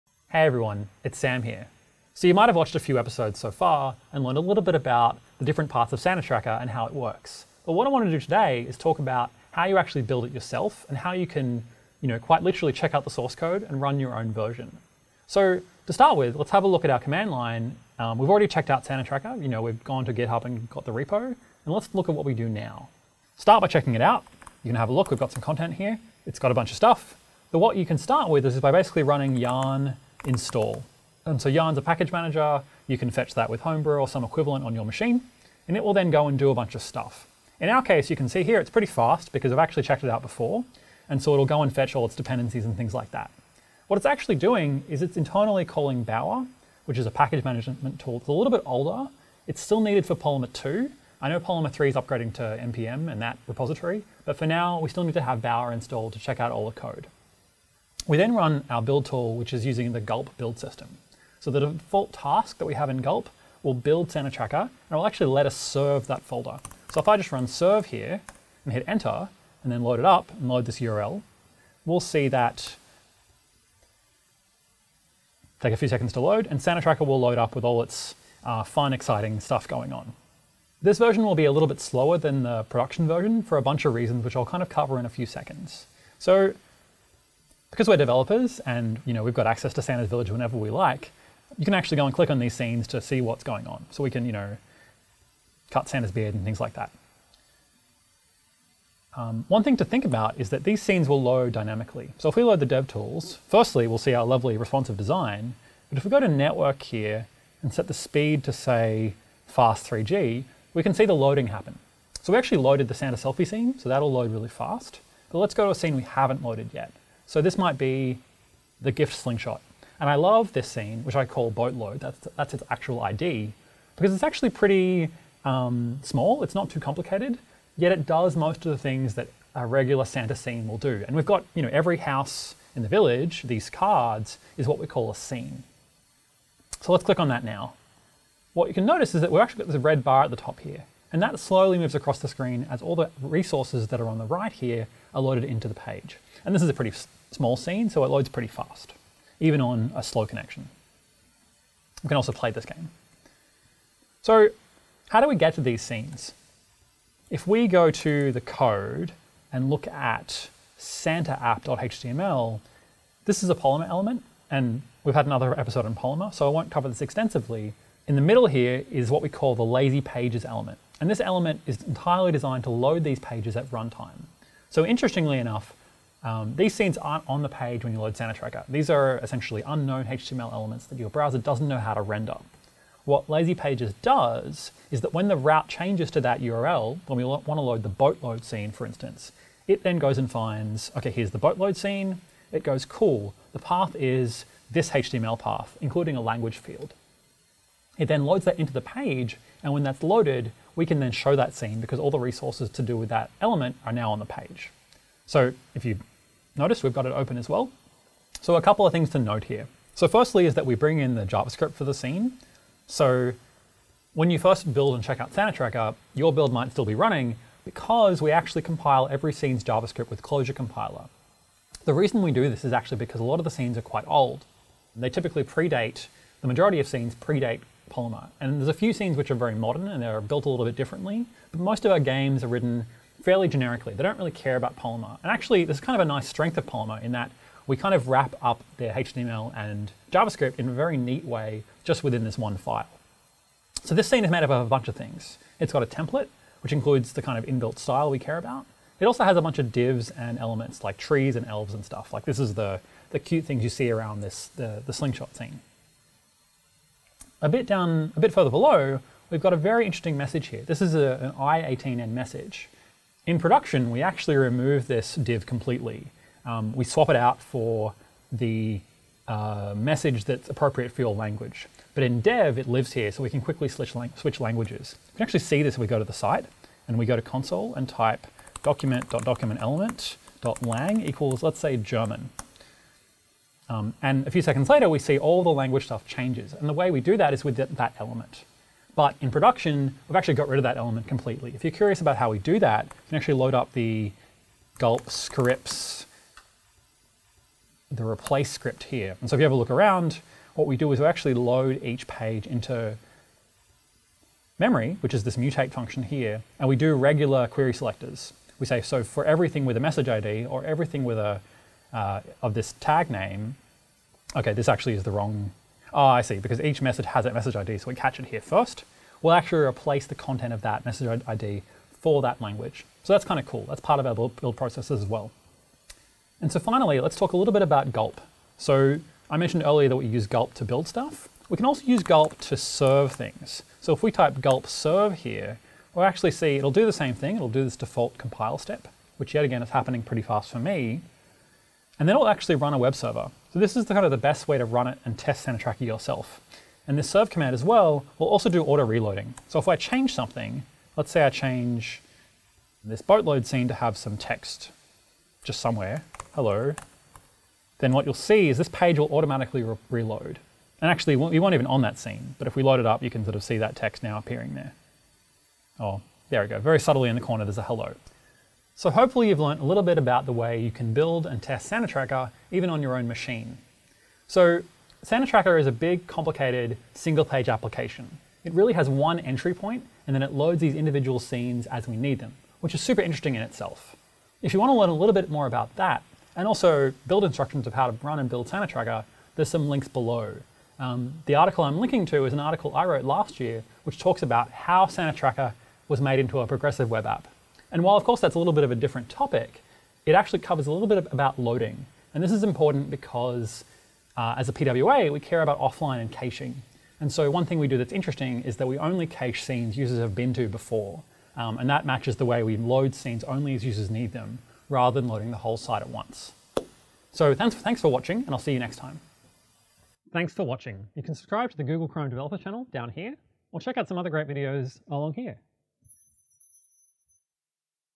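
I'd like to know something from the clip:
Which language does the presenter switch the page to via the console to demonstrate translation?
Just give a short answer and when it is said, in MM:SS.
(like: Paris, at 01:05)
German, at 04:41.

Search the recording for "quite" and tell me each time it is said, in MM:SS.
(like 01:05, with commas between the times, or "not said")
00:12, 03:43.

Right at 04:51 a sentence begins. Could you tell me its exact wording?
If you're curious about how we do that, you can actually load up the gulp scripts, the replace script here.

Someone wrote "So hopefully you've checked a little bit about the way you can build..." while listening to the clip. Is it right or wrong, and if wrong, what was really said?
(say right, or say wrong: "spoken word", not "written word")
wrong: "learned", not "checked".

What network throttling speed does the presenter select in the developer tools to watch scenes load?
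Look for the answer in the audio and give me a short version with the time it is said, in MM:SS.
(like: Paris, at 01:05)
fast 3G, at 01:49.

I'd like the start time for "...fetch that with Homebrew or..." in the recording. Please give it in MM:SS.
00:33.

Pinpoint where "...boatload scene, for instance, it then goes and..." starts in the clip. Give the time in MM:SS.
03:07.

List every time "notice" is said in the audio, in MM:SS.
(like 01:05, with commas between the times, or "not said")
02:18, 03:26.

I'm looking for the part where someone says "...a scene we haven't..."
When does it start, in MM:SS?
01:55.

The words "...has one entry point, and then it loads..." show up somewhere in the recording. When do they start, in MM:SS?
06:18.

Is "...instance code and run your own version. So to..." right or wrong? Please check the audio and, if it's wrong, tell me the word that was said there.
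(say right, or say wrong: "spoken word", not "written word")
wrong: "source", not "instance".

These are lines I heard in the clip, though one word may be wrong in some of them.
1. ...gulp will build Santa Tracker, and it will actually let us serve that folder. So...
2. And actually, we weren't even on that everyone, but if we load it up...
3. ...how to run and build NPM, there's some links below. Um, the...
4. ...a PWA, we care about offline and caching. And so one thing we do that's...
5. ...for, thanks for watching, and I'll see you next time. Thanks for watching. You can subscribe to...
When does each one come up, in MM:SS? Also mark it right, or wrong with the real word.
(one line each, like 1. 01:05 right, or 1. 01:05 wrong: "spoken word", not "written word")
1. 01:02 right
2. 06:00 wrong: "scene", not "everyone"
3. 06:27 wrong: "Tracker", not "NPM"
4. 06:44 right
5. 06:57 right.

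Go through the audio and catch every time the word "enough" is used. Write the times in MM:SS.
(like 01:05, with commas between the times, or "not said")
02:55.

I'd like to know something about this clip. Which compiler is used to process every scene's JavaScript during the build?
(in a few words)
Closure Compiler.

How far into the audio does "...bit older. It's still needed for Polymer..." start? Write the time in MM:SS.
00:48.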